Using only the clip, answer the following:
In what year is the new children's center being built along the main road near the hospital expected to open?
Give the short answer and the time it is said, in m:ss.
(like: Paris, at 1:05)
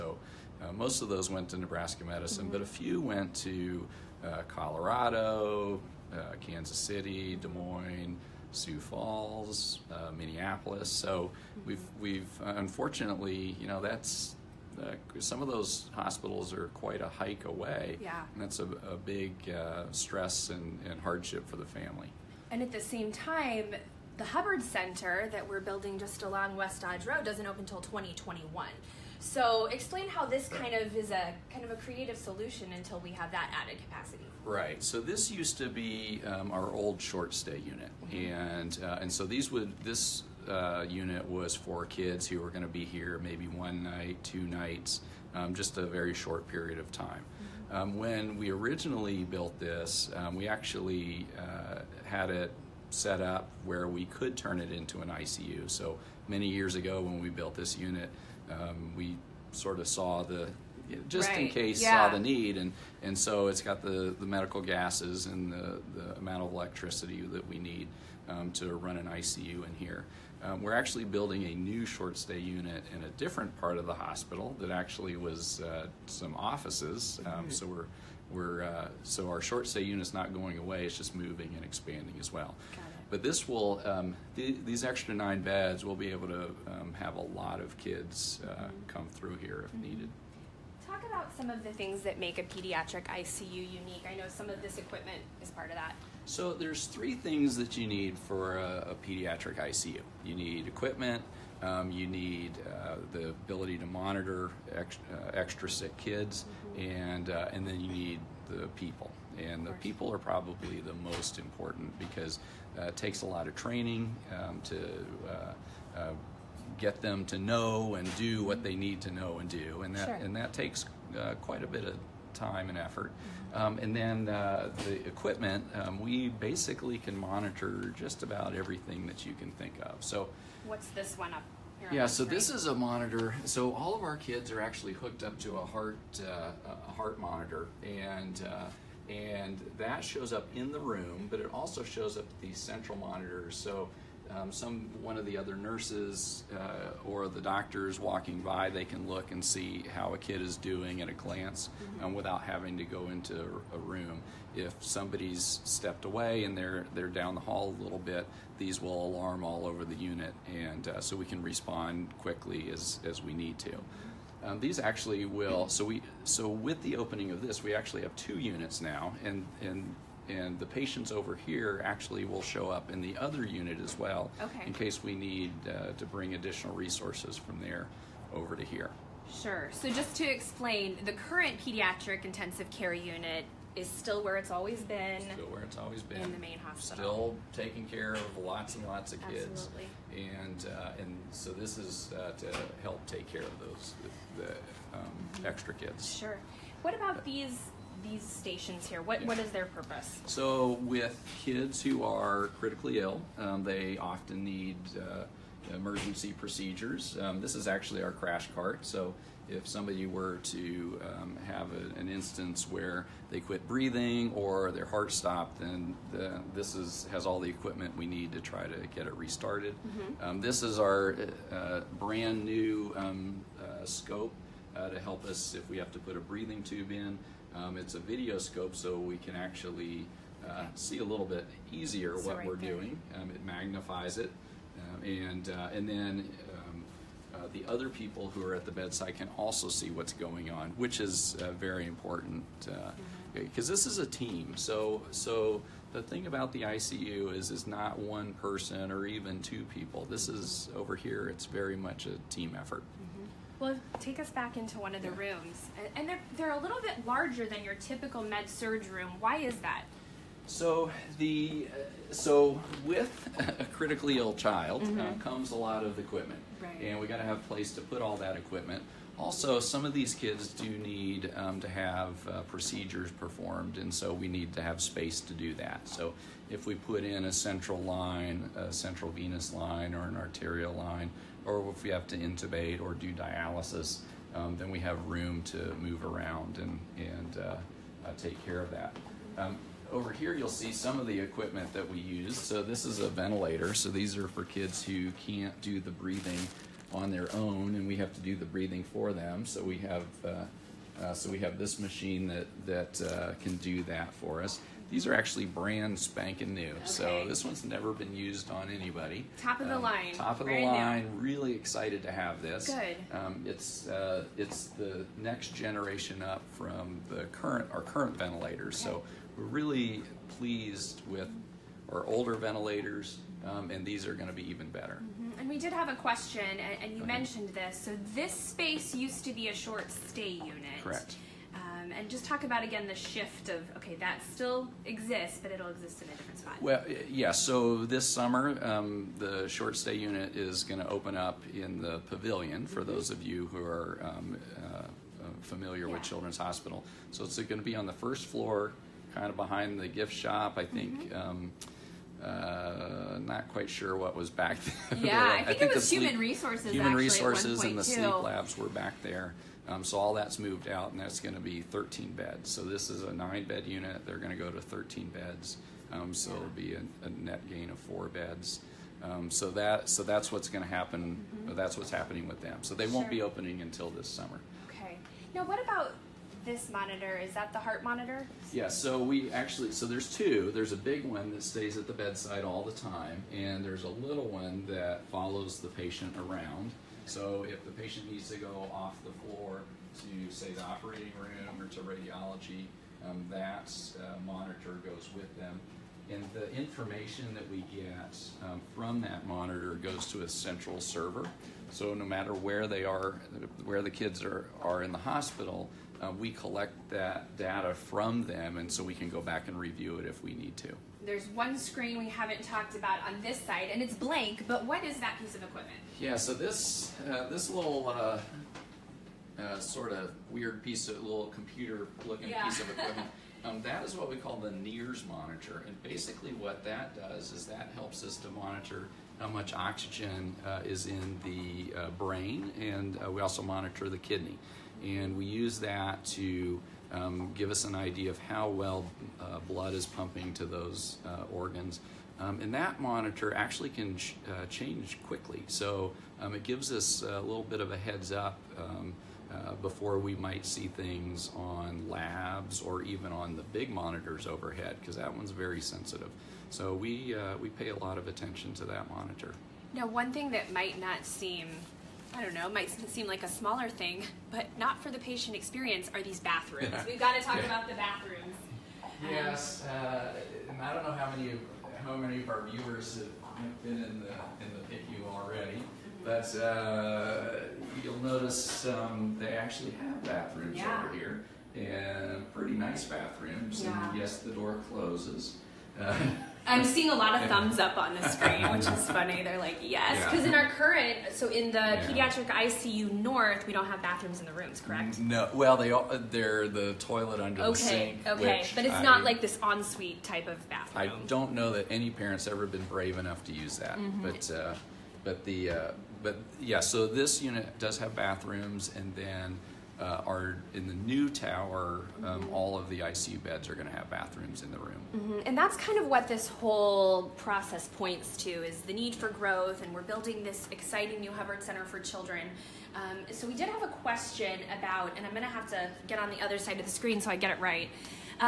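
2021, at 0:27.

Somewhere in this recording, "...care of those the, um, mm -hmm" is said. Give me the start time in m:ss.
3:13.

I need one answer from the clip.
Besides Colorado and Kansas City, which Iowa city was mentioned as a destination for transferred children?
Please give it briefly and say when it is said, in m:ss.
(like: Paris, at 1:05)
Des Moines, at 0:07.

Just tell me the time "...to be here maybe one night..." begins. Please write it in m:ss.
0:42.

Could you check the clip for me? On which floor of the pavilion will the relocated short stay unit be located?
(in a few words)
First floor.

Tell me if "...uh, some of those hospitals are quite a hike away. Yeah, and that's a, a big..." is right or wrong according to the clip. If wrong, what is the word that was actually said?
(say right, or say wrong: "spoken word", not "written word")
right.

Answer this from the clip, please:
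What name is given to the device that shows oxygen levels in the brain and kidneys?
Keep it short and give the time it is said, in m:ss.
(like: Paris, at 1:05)
NIRS monitor, at 7:04.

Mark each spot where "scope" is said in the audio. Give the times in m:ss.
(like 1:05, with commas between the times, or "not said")
3:43, 3:48.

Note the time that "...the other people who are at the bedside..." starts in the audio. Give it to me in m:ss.
3:57.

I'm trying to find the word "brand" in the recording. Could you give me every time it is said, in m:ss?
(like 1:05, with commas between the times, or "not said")
3:41, 5:05, 5:10.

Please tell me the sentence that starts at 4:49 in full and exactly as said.
Um, over here you'll see some of the equipment that we use.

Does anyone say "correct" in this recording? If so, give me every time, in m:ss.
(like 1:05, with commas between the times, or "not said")
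5:30, 8:14.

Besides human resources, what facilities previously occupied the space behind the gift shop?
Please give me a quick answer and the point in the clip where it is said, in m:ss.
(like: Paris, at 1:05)
Sleep labs, at 5:57.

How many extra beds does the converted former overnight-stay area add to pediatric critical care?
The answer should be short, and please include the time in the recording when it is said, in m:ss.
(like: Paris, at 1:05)
9, at 1:25.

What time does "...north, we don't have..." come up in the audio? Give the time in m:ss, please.
8:12.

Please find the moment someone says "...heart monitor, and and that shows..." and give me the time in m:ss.
2:16.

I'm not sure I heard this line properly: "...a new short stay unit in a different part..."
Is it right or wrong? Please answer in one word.
right.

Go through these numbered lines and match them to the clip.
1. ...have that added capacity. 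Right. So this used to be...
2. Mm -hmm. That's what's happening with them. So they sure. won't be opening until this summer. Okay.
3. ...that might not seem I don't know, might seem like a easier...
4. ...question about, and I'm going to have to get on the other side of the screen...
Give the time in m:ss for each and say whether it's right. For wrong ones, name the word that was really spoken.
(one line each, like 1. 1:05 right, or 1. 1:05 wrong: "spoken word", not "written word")
1. 0:33 right
2. 6:11 right
3. 7:40 wrong: "smaller", not "easier"
4. 8:43 right.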